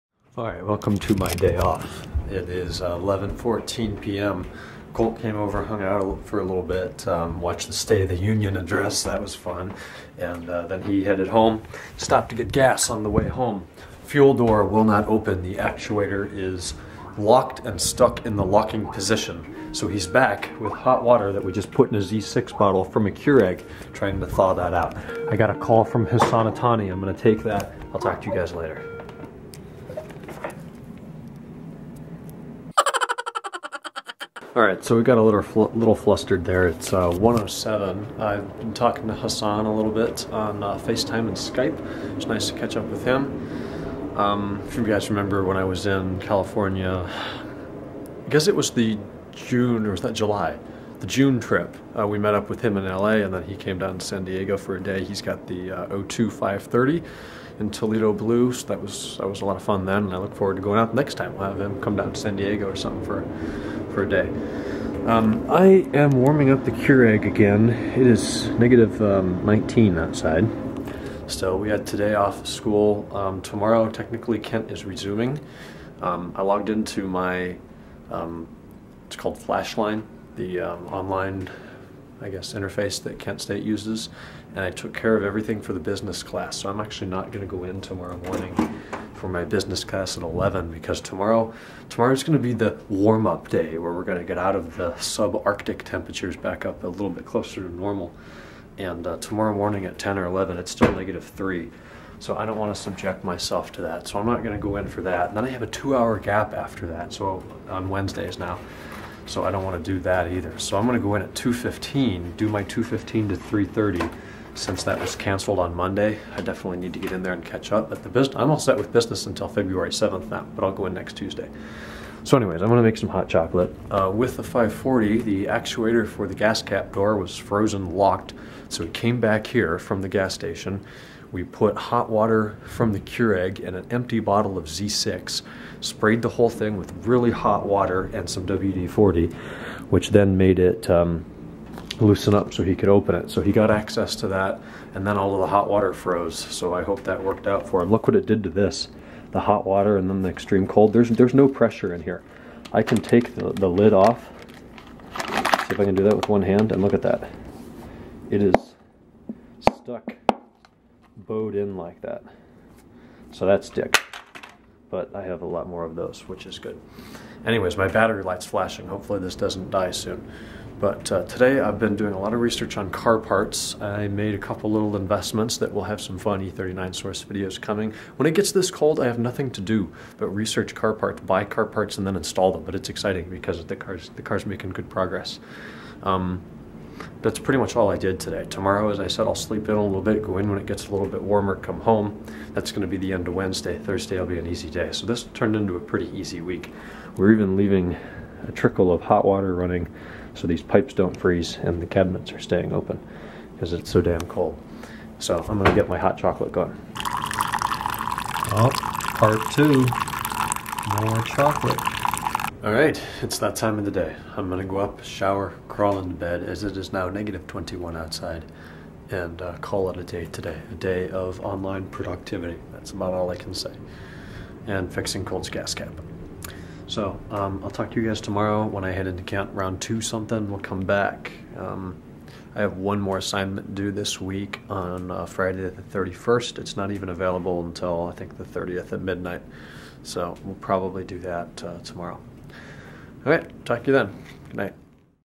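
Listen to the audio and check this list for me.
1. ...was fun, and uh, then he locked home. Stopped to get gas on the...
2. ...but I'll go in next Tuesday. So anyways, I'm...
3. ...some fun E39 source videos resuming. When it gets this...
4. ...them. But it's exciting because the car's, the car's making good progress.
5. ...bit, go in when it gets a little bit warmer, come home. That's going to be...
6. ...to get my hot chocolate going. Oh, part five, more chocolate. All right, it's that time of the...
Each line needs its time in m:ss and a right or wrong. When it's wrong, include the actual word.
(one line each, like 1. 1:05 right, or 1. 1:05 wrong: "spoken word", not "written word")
1. 0:09 wrong: "headed", not "locked"
2. 2:00 right
3. 2:56 wrong: "coming", not "resuming"
4. 3:02 right
5. 3:10 right
6. 3:25 wrong: "two", not "five".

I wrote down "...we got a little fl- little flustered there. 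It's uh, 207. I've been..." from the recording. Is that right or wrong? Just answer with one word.
wrong.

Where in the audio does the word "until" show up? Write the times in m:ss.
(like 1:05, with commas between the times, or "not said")
1:59, 3:57.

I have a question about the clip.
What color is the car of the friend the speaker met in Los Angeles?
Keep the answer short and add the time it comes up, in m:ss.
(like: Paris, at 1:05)
Toledo Blue, at 0:57.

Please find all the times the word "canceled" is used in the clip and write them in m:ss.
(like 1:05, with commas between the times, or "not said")
1:55.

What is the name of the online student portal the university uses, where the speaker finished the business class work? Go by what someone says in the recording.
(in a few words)
Flashline.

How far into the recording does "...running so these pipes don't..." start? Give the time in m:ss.
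3:19.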